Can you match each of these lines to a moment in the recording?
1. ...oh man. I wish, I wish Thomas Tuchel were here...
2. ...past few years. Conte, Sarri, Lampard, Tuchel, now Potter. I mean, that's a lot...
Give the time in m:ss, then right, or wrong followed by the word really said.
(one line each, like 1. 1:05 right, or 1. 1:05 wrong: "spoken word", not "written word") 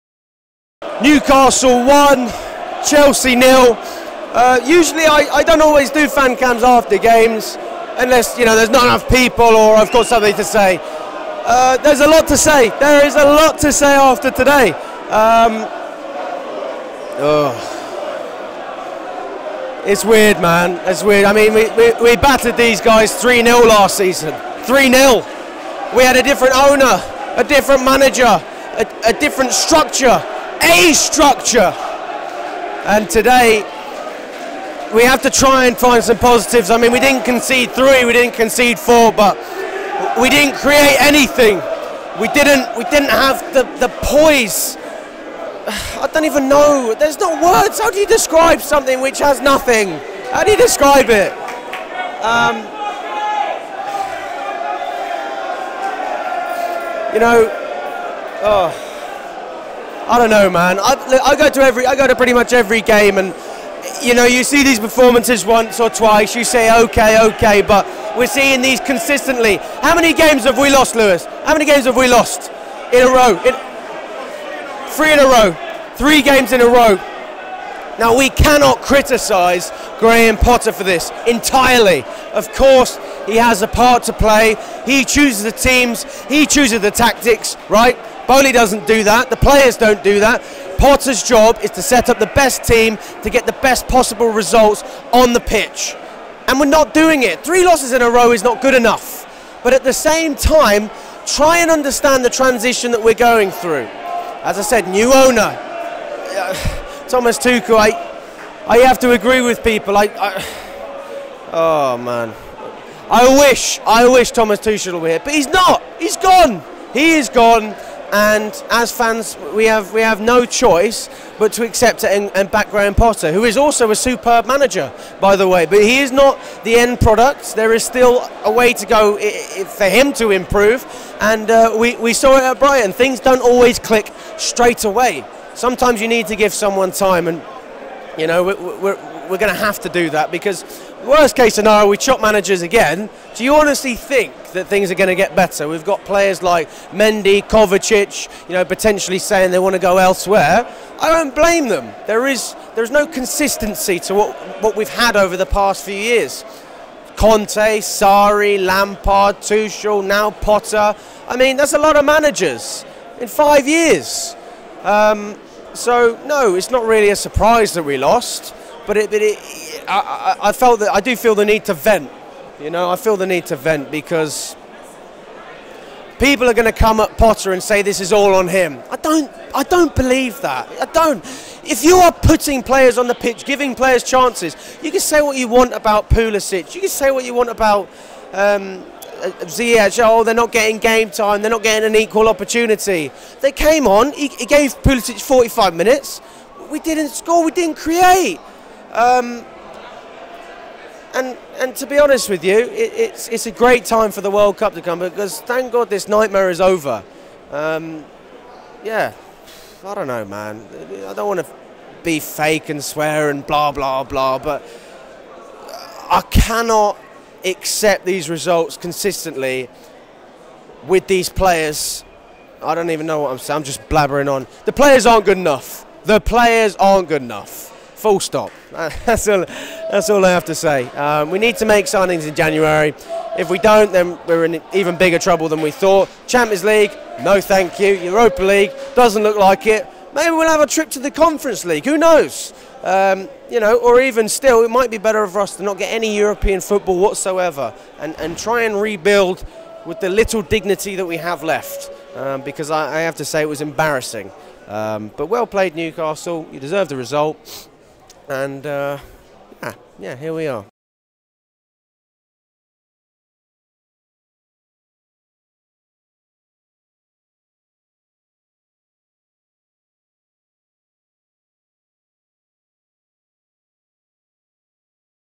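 1. 1:51 right
2. 2:35 right.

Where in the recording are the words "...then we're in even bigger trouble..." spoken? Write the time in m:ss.
3:53.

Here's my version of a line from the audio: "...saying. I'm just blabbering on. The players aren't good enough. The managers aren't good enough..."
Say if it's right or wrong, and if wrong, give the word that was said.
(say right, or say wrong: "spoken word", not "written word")
wrong: "players", not "managers".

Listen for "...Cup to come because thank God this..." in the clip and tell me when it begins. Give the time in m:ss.
3:24.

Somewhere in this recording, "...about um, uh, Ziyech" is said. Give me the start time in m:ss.
3:07.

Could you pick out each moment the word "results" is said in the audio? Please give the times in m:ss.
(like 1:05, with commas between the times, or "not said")
1:34, 3:38, 4:16.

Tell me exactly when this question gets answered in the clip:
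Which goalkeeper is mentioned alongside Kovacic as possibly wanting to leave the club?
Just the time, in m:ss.
2:26.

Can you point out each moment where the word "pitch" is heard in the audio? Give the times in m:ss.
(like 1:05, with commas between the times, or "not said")
1:35, 3:03.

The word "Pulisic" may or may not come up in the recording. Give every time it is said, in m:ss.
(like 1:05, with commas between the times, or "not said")
3:06, 3:14.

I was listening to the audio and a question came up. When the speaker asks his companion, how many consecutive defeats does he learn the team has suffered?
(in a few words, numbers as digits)
3.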